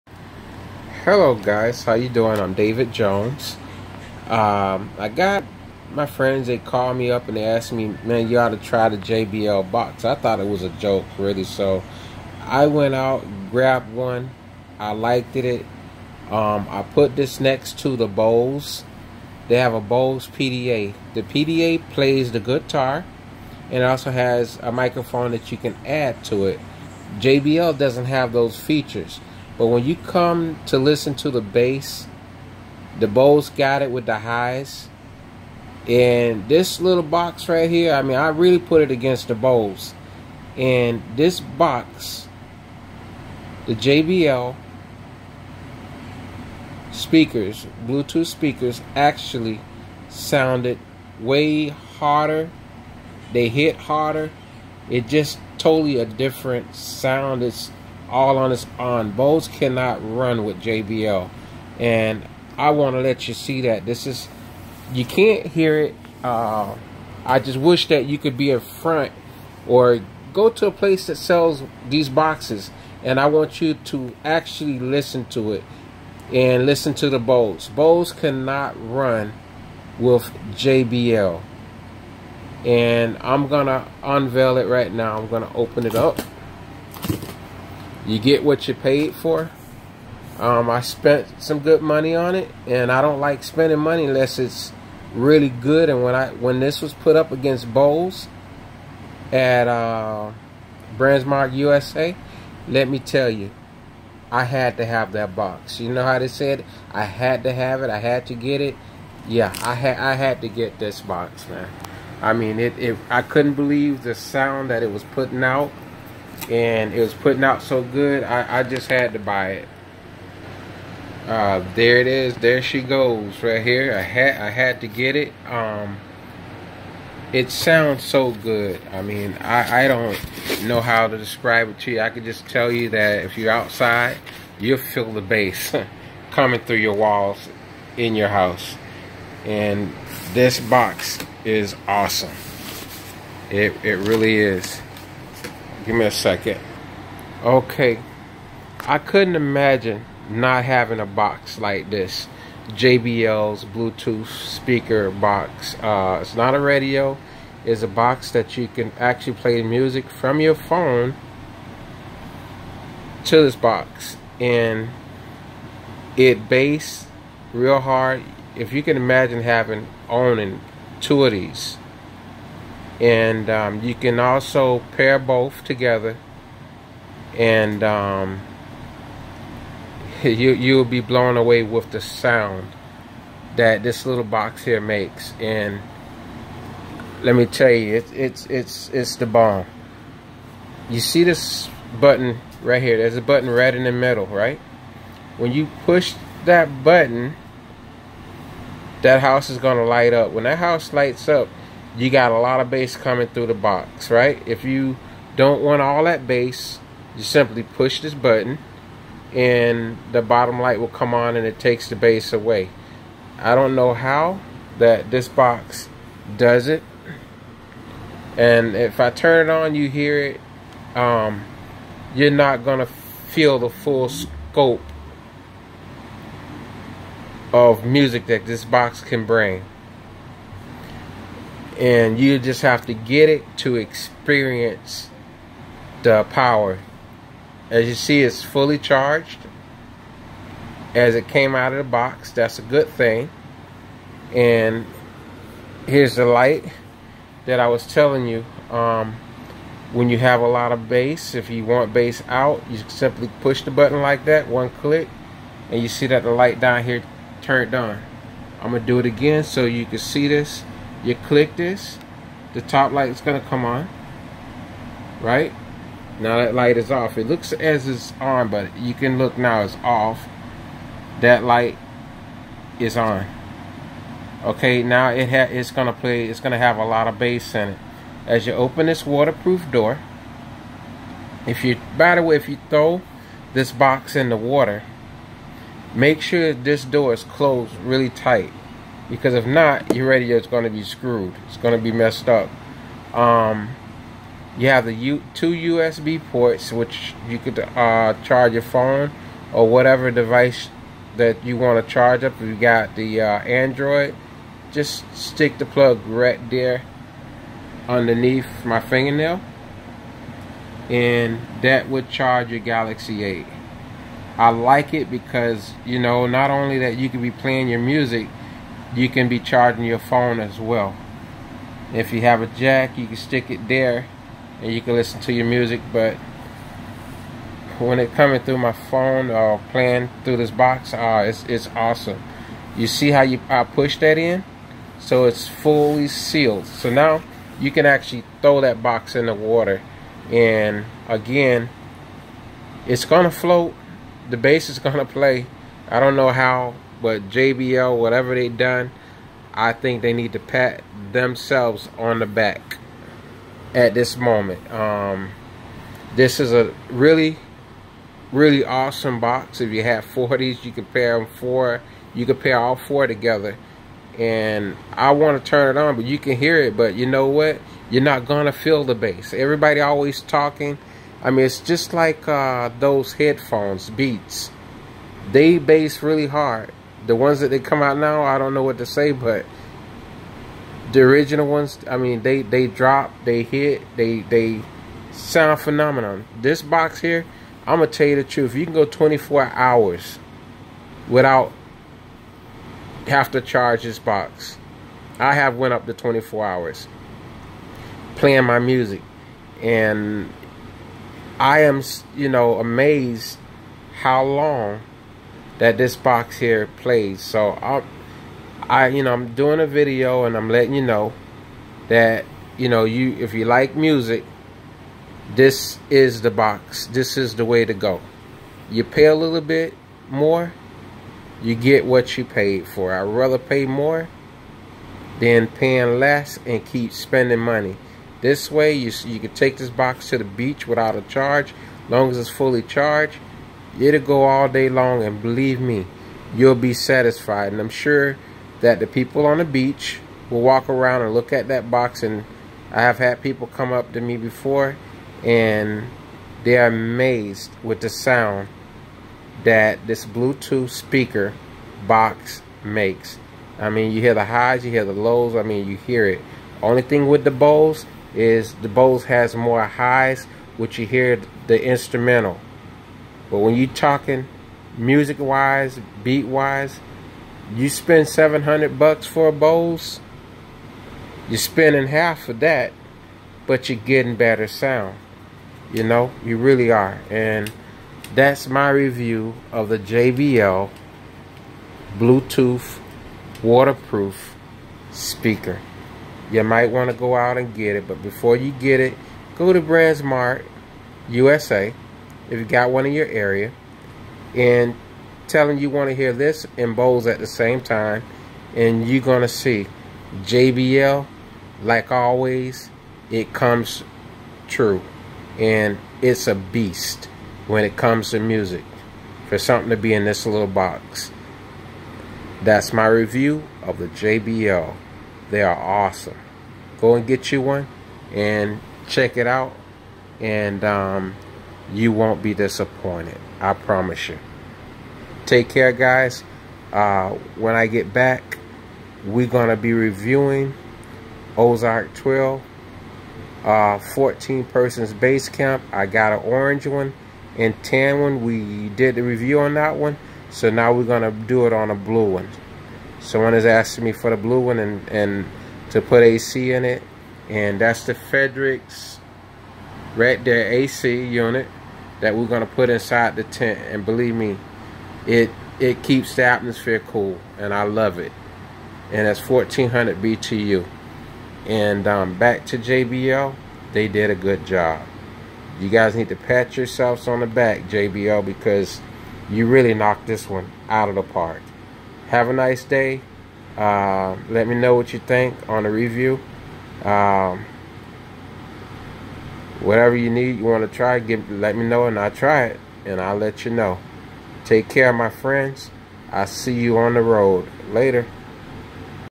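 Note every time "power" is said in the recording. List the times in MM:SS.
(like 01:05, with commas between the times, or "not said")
03:56.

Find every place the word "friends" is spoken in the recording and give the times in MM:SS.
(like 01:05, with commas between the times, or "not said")
00:06, 09:45.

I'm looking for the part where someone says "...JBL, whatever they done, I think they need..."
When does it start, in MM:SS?
05:47.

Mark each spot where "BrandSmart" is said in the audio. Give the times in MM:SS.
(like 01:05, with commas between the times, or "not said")
01:40, 08:09.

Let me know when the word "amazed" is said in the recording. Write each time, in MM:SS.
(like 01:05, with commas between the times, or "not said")
06:42, 07:26.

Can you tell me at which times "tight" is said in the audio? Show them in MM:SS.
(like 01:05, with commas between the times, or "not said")
04:48.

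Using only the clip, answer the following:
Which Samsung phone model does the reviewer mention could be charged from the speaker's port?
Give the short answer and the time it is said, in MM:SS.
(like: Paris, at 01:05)
Galaxy 8, at 05:12.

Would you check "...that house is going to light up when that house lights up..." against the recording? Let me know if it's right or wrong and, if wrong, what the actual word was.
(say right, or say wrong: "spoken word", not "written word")
right.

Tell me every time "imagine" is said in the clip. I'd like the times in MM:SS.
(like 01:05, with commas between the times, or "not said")
02:29, 02:48.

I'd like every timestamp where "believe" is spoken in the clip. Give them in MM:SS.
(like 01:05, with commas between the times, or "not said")
01:53, 07:15, 09:13.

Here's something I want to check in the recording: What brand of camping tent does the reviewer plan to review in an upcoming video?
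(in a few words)
Ozark.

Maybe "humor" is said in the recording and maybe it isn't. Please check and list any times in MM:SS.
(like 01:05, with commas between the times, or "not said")
not said.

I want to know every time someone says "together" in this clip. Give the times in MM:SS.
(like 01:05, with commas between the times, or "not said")
02:55, 06:03.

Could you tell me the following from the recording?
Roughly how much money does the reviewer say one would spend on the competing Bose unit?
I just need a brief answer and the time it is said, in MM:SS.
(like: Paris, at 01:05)
$700, at 07:48.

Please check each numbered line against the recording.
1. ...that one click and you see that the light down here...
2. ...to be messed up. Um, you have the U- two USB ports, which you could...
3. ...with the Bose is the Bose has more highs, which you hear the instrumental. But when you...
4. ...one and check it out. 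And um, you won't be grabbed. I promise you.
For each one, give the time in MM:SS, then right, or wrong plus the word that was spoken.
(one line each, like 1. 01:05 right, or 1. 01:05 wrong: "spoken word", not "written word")
1. 04:14 right
2. 04:51 right
3. 07:37 right
4. 08:37 wrong: "disappointed", not "grabbed".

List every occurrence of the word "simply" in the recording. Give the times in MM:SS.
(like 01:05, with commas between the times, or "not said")
03:27, 04:12.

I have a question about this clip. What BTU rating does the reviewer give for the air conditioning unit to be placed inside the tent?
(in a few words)
1400.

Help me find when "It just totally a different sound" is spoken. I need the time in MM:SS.
00:54.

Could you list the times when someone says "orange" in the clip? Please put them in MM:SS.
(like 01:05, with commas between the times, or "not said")
08:56.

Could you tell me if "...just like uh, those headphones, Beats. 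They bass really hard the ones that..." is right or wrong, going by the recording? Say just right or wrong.
right.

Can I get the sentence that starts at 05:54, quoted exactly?
Um, this is a really, really awesome box.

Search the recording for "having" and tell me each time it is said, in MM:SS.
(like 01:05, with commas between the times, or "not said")
02:30, 02:49.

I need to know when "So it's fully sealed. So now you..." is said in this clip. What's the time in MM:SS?
05:34.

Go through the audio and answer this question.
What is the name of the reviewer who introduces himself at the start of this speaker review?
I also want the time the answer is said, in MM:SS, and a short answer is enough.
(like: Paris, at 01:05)
David Jones, at 00:02.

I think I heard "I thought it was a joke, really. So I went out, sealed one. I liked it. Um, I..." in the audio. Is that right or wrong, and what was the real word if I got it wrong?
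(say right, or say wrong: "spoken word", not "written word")
wrong: "grabbed", not "sealed".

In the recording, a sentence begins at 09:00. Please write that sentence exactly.
So now we're going to do it on a blue one.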